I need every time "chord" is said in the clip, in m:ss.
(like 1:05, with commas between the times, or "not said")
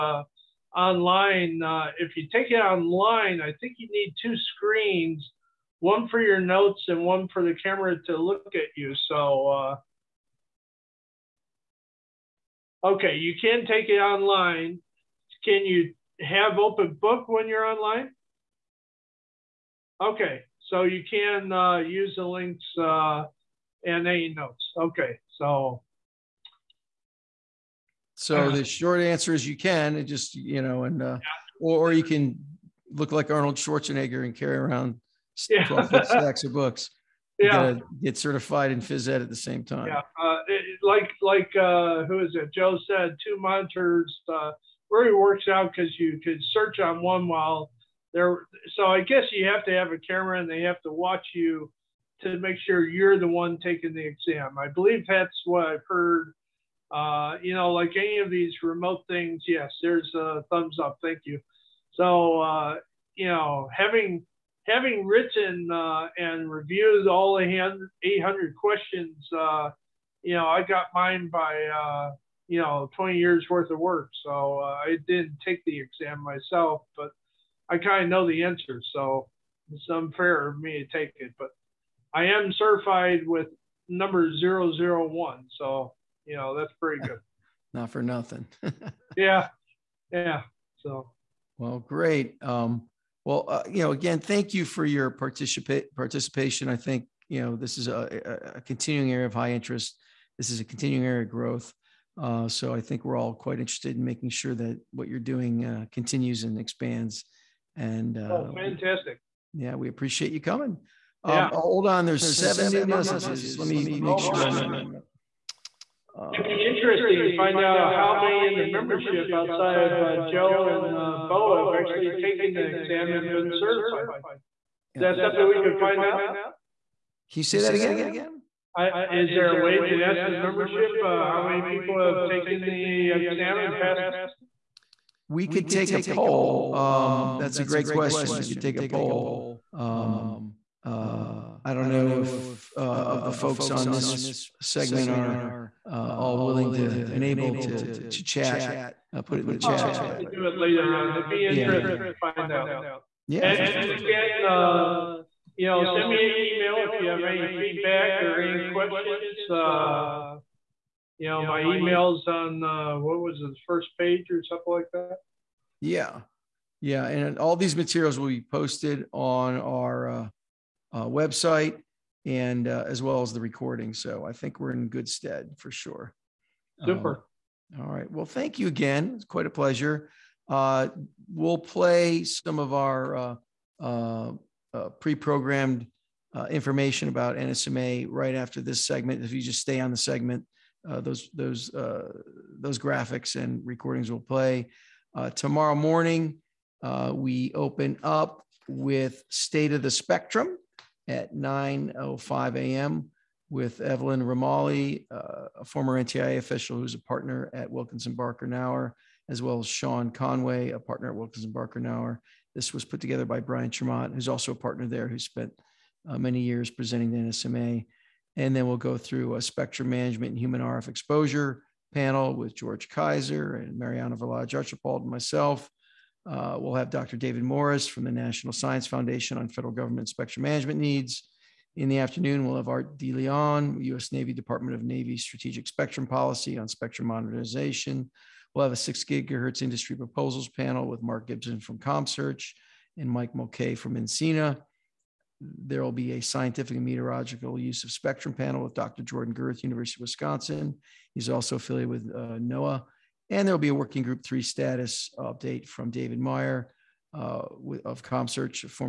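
not said.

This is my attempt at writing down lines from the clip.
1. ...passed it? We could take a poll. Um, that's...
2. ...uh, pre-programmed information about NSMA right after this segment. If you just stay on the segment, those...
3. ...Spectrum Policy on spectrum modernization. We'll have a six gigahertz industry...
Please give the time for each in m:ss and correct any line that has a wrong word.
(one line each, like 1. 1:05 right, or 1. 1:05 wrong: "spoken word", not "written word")
1. 2:13 right
2. 3:04 right
3. 3:55 right.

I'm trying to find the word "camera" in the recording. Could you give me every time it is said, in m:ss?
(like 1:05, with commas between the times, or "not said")
0:07, 0:49.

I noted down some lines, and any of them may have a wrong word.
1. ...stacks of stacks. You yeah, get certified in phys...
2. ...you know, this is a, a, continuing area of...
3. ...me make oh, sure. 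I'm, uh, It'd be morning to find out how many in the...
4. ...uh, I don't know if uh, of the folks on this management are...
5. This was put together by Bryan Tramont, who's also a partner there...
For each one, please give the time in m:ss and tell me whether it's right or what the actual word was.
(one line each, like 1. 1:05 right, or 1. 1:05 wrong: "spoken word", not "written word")
1. 0:35 wrong: "books", not "stacks"
2. 1:37 right
3. 1:53 wrong: "interesting", not "morning"
4. 2:20 wrong: "segment", not "management"
5. 3:32 right.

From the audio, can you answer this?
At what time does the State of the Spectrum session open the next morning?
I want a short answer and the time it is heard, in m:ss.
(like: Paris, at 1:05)
9:05 a.m., at 3:21.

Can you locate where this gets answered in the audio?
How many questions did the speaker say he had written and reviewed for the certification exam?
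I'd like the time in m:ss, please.
1:08.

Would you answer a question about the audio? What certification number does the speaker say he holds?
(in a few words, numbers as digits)
001.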